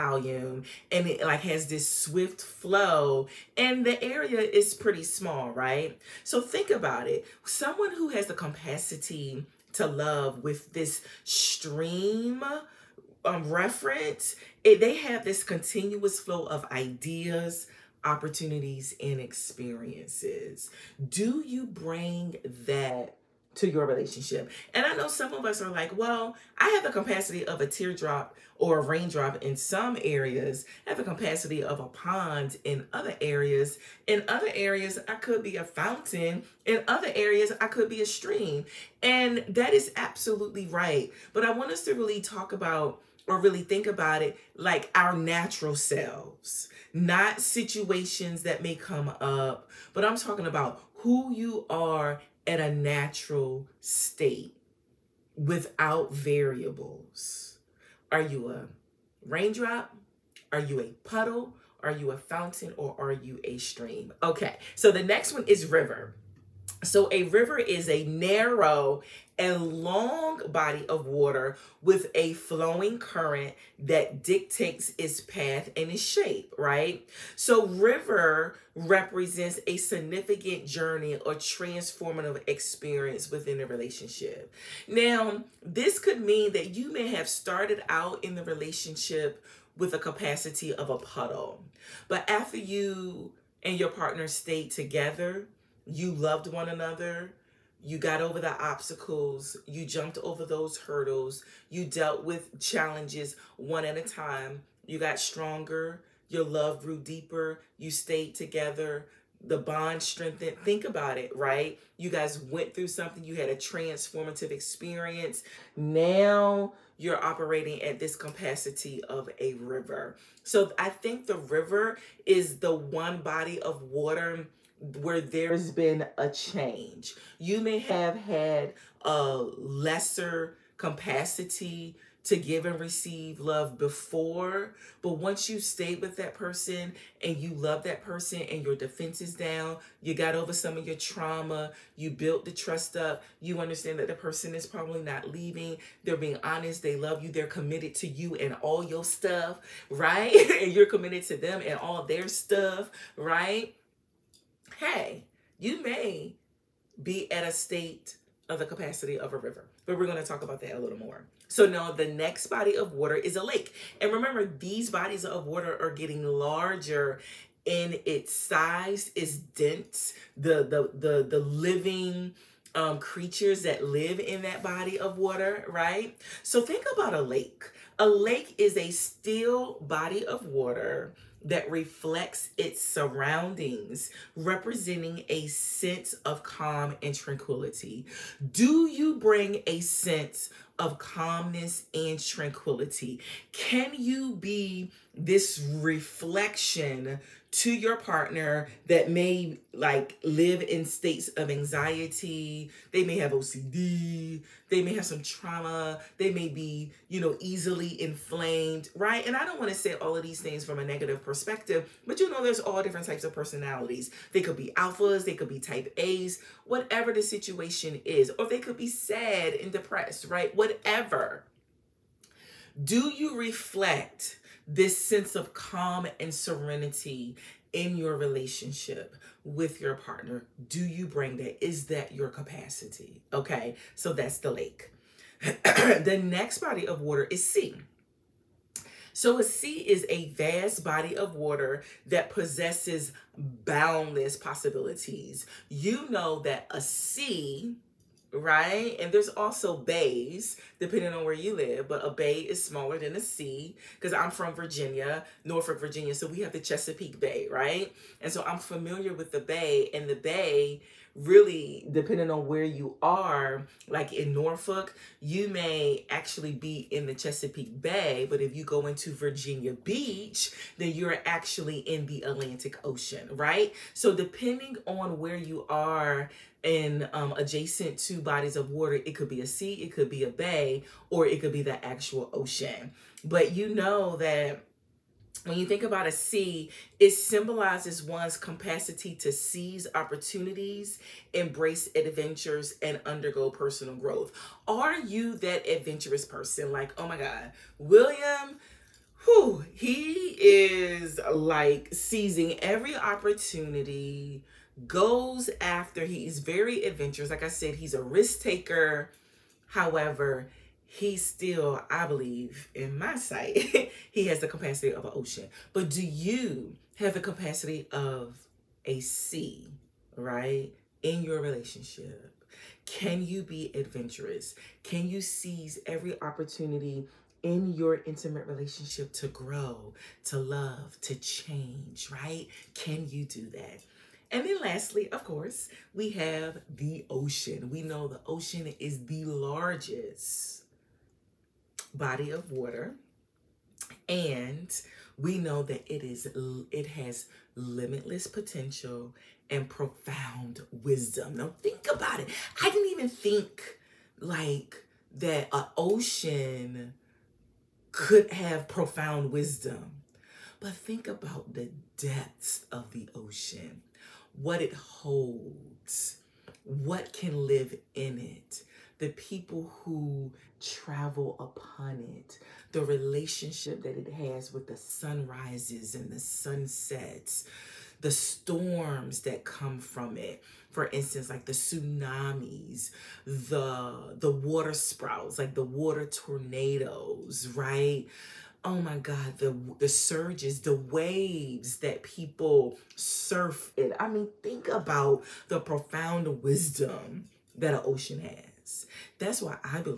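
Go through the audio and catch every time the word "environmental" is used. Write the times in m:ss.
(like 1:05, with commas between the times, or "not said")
not said.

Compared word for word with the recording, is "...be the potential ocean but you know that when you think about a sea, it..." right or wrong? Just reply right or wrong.
wrong.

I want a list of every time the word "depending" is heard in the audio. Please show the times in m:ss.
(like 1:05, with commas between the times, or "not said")
4:10, 4:21, 4:34.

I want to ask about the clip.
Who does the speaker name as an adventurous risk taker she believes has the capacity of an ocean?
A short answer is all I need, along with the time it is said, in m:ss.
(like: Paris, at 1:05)
William, at 4:57.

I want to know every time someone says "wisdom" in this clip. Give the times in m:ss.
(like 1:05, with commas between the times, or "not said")
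5:50, 5:59, 6:36.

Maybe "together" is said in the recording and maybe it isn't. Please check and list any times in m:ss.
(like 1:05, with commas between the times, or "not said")
1:34, 1:48.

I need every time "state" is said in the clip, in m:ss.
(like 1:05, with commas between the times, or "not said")
0:53, 2:37, 3:20.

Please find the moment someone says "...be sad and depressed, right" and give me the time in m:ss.
3:38.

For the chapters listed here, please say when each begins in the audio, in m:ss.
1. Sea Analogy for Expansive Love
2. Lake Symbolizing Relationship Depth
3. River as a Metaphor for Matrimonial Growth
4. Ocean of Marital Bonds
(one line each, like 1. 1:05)
1. 3:54
2. 2:41
3. 1:04
4. 5:34.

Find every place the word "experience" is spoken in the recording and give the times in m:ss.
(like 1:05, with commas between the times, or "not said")
0:19, 1:22, 1:54.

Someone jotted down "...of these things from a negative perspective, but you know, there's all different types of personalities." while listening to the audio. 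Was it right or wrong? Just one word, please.
right.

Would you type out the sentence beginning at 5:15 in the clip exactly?
But do you have the capacity of a sea, right?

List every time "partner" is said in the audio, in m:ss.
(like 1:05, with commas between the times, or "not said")
1:33, 3:17, 3:49.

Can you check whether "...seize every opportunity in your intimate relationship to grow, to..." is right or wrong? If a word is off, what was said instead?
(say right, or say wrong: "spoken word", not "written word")
right.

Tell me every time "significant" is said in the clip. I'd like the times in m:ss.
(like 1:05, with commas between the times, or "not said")
1:19.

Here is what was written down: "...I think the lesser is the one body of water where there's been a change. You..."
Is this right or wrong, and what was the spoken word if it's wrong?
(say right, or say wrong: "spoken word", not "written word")
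wrong: "river", not "lesser".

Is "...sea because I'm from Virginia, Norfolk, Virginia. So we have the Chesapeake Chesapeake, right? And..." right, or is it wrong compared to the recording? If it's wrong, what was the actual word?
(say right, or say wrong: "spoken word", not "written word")
wrong: "Bay", not "Chesapeake".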